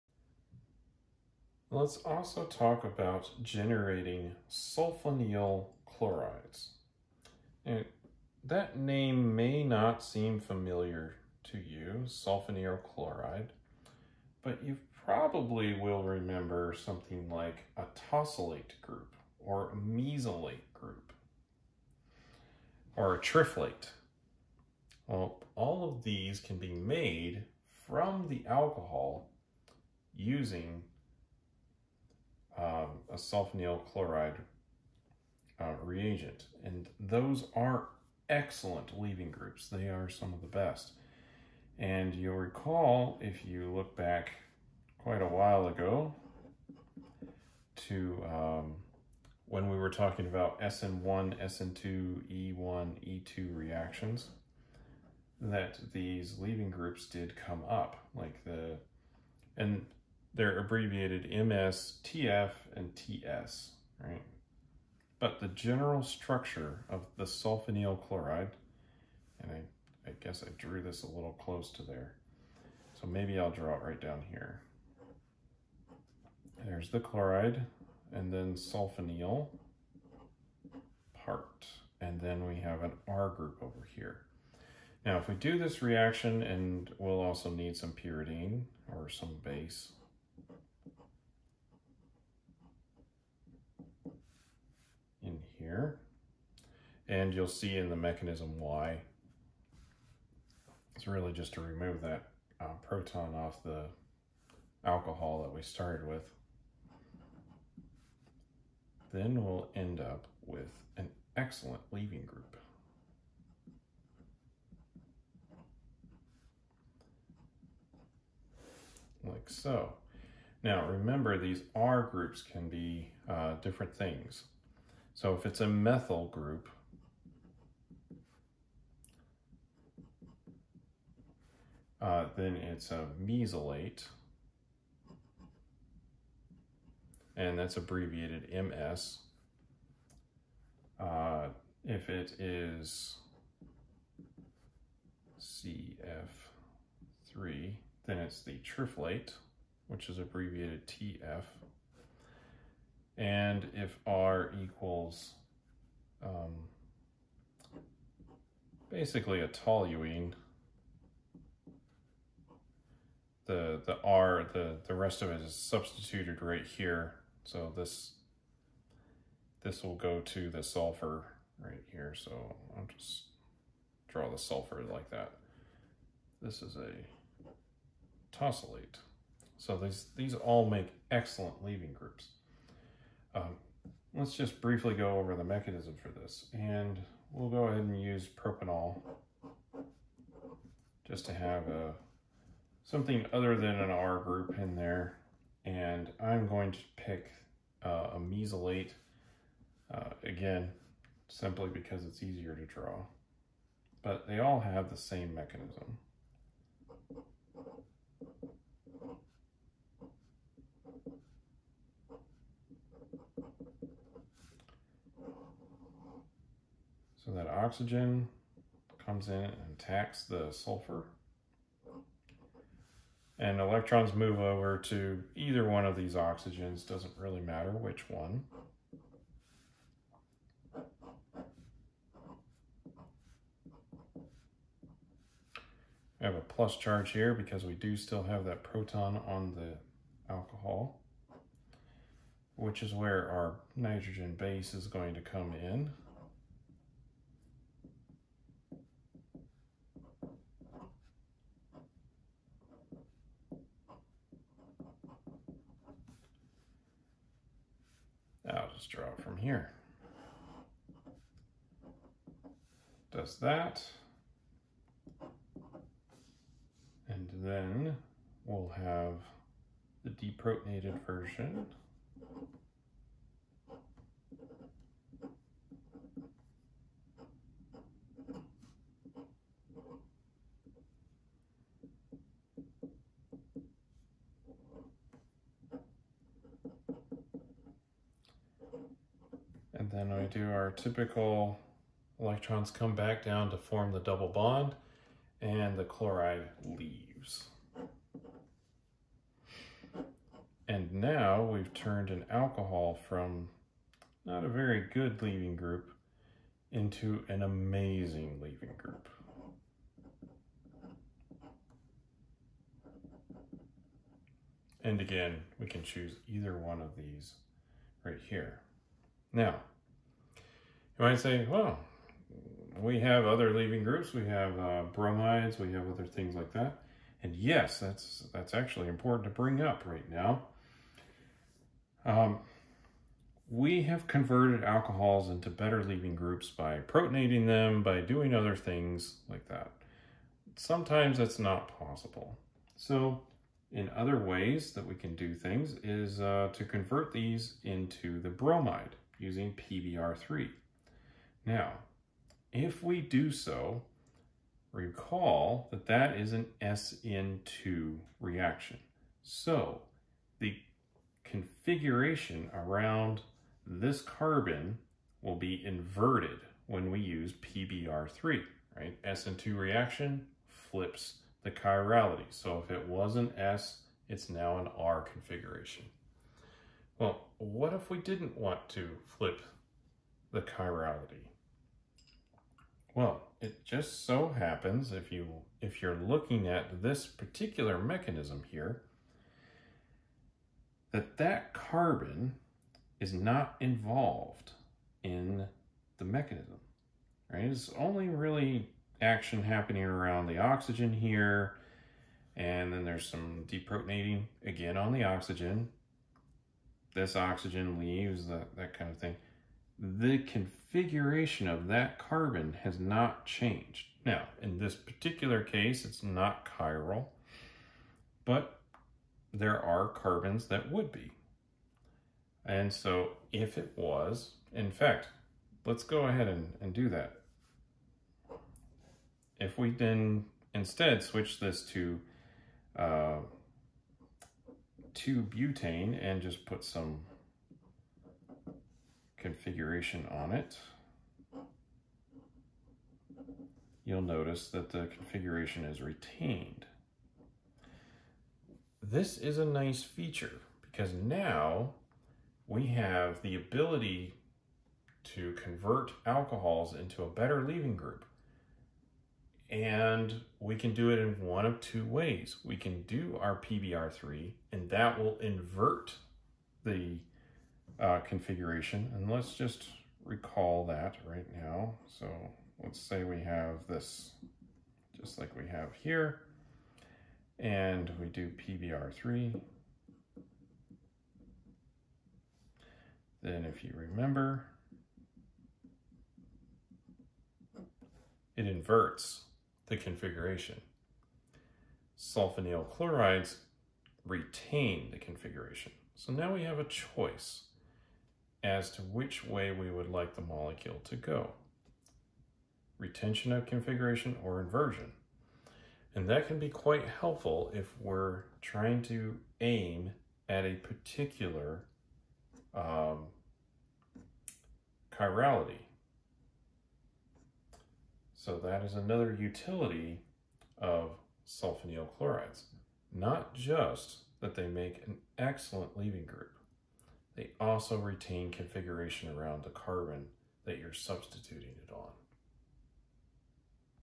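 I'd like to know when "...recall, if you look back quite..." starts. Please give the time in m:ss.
0:42.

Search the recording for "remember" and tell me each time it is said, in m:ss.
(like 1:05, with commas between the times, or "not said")
0:16, 2:00, 8:03.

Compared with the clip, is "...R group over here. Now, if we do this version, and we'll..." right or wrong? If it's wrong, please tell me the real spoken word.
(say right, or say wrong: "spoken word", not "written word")
wrong: "reaction", not "version".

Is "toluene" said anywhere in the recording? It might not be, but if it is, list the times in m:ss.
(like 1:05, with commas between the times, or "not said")
2:39.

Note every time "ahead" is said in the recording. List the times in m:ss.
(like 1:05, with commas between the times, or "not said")
3:07, 7:06.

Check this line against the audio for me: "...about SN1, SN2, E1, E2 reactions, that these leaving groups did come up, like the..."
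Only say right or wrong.
right.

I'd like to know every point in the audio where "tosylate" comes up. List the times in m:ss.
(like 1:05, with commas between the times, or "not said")
0:18, 2:58.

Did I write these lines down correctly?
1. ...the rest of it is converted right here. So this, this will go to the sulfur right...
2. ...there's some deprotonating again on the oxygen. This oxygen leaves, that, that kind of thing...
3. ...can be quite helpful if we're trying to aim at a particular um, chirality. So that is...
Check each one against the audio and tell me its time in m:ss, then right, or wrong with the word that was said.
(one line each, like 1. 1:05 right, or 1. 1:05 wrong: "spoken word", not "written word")
1. 2:44 wrong: "substituted", not "converted"
2. 6:42 right
3. 8:26 right.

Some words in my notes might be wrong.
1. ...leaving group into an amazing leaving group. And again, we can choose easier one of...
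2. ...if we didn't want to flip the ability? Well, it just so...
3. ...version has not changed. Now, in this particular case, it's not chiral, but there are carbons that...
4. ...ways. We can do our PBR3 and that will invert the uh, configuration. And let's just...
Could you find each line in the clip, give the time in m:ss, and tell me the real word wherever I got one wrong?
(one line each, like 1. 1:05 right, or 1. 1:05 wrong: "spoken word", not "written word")
1. 5:05 wrong: "either", not "easier"
2. 6:17 wrong: "chirality", not "ability"
3. 6:51 wrong: "carbon", not "version"
4. 7:41 right.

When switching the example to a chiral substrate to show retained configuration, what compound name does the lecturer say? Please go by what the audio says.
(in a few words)
2-butane.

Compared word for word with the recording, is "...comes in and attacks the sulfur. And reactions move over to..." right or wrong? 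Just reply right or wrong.
wrong.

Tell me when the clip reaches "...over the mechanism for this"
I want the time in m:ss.
3:05.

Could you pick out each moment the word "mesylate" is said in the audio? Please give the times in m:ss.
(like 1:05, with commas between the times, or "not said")
0:19, 2:13, 3:18.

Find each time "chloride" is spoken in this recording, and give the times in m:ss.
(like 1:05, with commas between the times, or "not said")
0:05, 0:12, 0:33, 1:08, 1:16, 4:55, 8:12, 8:41.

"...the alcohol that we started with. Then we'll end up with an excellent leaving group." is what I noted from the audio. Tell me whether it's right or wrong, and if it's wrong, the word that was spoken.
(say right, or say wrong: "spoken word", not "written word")
right.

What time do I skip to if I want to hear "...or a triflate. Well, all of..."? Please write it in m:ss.
0:22.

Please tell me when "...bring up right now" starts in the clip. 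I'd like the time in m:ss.
5:29.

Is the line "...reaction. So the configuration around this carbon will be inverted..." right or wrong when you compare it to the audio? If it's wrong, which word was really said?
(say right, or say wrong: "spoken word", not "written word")
right.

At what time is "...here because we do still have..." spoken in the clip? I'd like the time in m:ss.
3:57.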